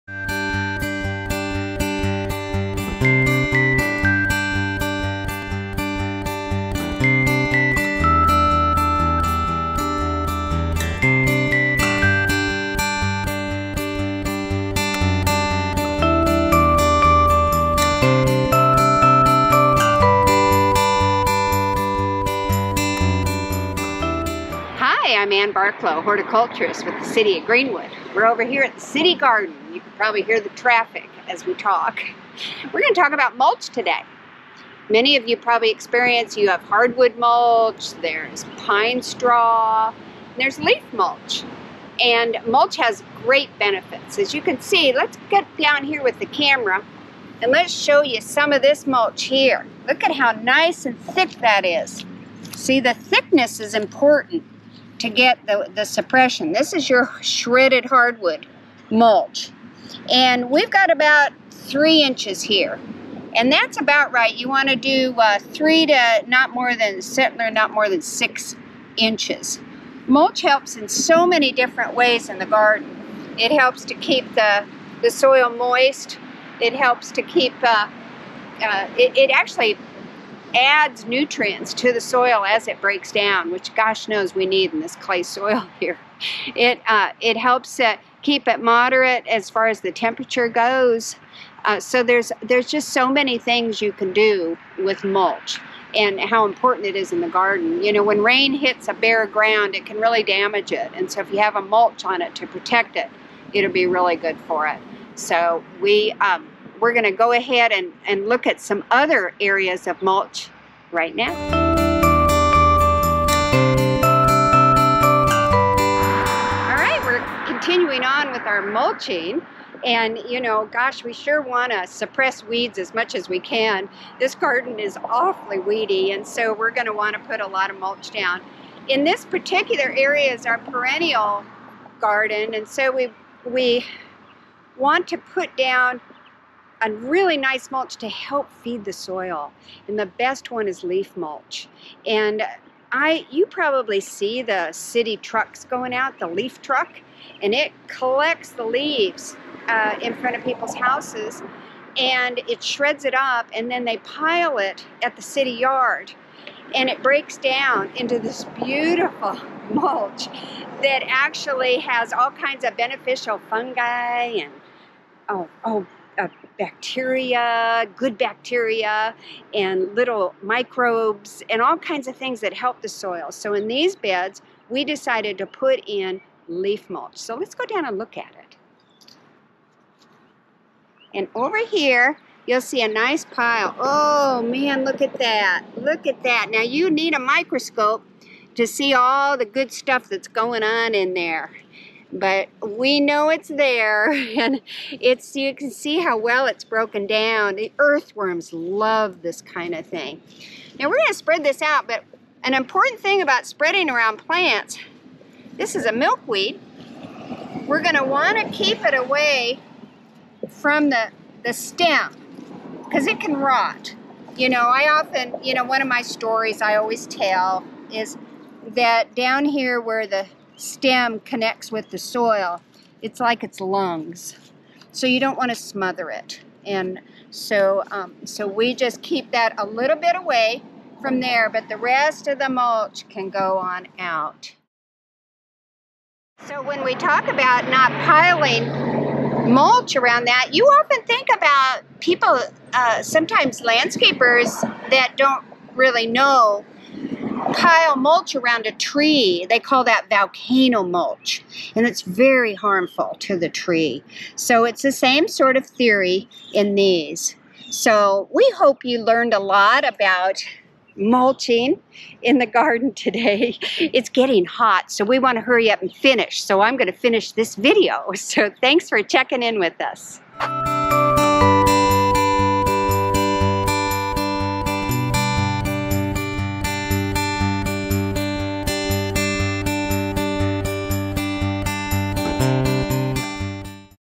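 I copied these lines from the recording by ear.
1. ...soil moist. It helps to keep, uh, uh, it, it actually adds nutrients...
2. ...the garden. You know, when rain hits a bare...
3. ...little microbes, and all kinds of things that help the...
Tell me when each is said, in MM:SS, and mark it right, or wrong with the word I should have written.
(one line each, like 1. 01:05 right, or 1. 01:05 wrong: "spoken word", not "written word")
1. 01:15 right
2. 01:37 right
3. 02:49 right.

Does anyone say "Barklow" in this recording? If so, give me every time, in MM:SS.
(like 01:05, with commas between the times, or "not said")
00:25.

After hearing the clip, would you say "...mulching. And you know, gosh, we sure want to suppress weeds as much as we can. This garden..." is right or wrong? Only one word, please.
right.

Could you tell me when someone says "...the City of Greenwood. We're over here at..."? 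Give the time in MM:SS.
00:26.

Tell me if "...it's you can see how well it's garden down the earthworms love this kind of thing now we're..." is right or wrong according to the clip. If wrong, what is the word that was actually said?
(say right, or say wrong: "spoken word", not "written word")
wrong: "broken", not "garden".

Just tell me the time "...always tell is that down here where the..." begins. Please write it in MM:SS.
03:36.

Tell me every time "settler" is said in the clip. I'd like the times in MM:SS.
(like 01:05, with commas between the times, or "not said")
01:07.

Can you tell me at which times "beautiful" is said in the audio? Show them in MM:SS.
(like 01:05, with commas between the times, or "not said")
02:38.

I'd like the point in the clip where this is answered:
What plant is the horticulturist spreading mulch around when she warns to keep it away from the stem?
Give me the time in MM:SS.
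03:25.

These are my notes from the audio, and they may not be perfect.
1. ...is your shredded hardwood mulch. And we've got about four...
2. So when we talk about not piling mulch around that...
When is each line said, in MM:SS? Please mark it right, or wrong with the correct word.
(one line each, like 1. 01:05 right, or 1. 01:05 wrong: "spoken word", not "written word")
1. 00:56 wrong: "three", not "four"
2. 03:56 right.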